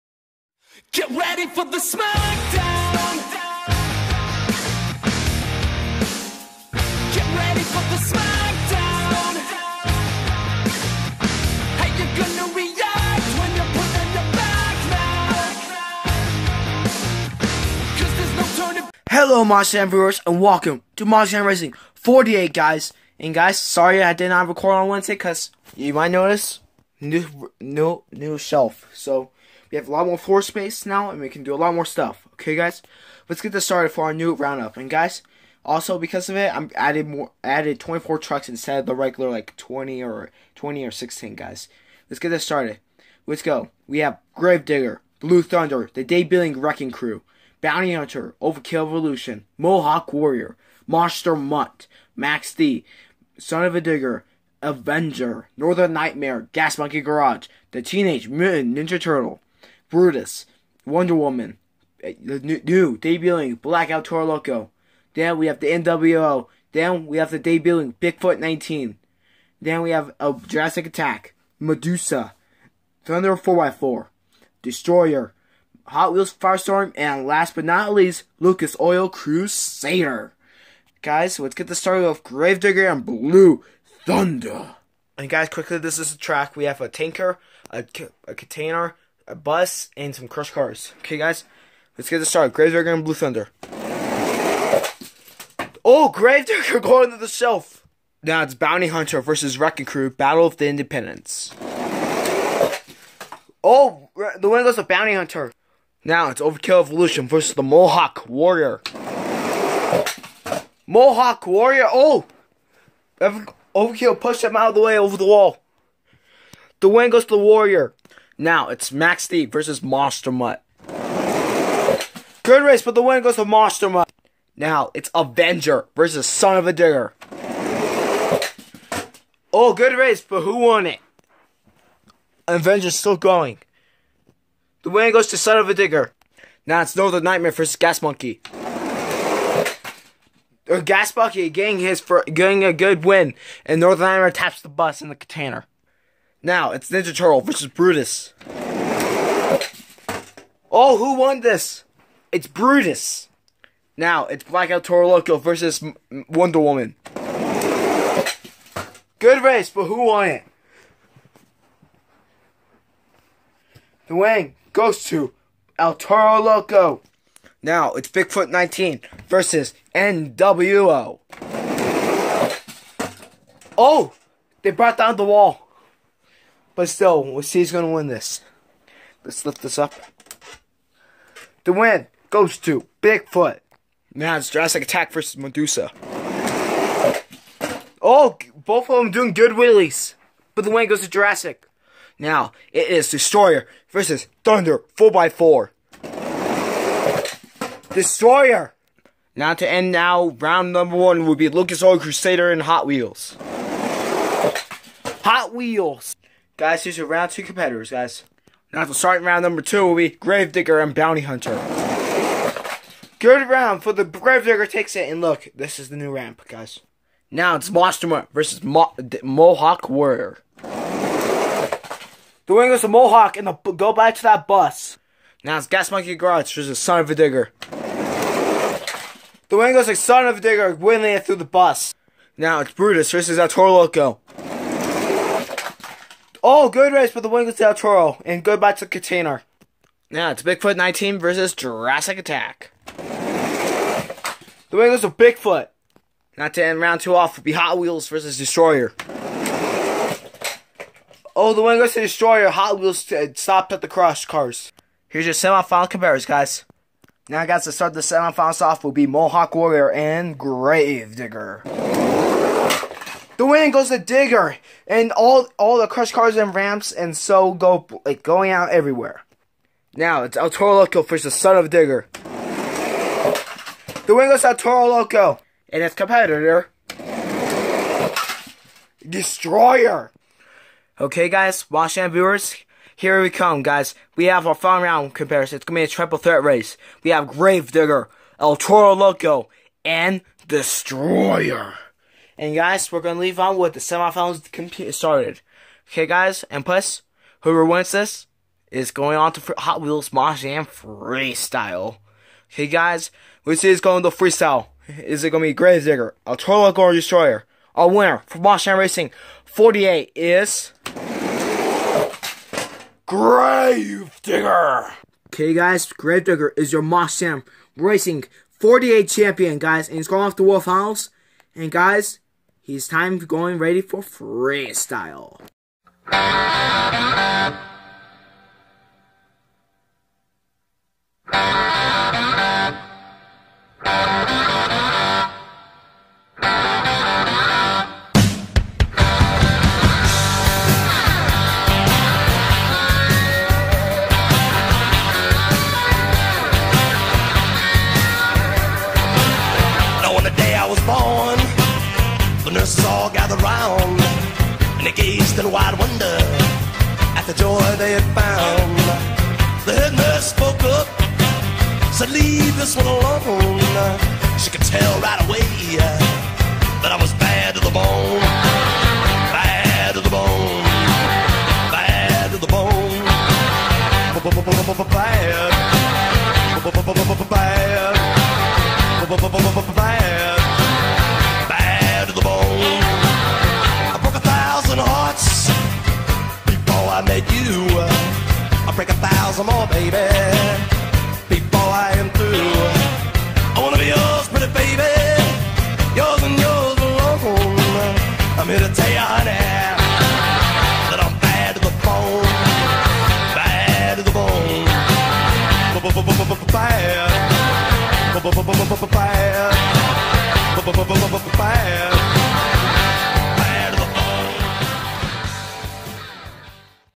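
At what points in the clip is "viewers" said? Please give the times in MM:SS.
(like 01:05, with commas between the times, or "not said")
00:19, 04:42.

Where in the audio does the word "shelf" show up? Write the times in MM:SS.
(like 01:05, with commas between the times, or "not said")
00:28, 01:37.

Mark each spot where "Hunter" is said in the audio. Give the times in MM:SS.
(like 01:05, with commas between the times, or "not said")
00:47, 01:38, 01:45, 03:31.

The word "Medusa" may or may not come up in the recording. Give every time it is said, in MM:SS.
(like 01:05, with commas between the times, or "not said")
01:11, 03:05.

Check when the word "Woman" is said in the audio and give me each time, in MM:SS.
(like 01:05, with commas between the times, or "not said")
01:01, 02:36.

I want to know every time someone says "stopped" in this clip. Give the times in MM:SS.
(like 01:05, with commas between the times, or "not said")
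04:13.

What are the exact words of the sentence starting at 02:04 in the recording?
Now it's Avenger versus Son of a Digger.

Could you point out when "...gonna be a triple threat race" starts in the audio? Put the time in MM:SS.
04:45.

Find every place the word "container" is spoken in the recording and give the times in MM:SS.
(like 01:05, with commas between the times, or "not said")
01:28, 02:25, 03:58.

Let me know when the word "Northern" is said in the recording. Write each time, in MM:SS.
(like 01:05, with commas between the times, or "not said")
00:55, 02:16, 02:23.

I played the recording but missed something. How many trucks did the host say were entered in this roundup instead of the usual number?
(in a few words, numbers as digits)
24.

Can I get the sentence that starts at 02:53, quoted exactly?
Oh, they brought down the wall.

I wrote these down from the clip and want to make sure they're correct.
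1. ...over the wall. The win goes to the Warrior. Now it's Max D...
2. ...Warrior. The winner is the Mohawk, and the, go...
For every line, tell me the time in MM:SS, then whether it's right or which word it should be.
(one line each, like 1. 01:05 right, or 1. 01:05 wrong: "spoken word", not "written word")
1. 01:54 right
2. 03:39 right.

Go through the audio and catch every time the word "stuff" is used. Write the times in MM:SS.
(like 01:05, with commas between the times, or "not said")
00:31.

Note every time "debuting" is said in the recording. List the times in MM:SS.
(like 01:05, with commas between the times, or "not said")
01:02, 01:07.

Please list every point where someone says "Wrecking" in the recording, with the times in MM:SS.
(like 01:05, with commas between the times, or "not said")
00:46, 01:39.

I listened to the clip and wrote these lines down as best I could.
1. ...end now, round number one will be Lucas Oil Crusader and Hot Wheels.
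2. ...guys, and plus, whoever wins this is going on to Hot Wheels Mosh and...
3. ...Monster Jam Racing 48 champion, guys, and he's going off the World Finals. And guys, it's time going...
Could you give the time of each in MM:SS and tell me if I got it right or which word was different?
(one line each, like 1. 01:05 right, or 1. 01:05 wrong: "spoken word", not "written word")
1. 03:19 right
2. 04:56 right
3. 05:16 right.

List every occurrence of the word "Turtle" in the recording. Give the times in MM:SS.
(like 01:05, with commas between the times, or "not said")
00:58, 02:27.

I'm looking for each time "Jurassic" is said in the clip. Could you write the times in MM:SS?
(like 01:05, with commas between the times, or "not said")
01:10, 03:04, 03:11, 04:01.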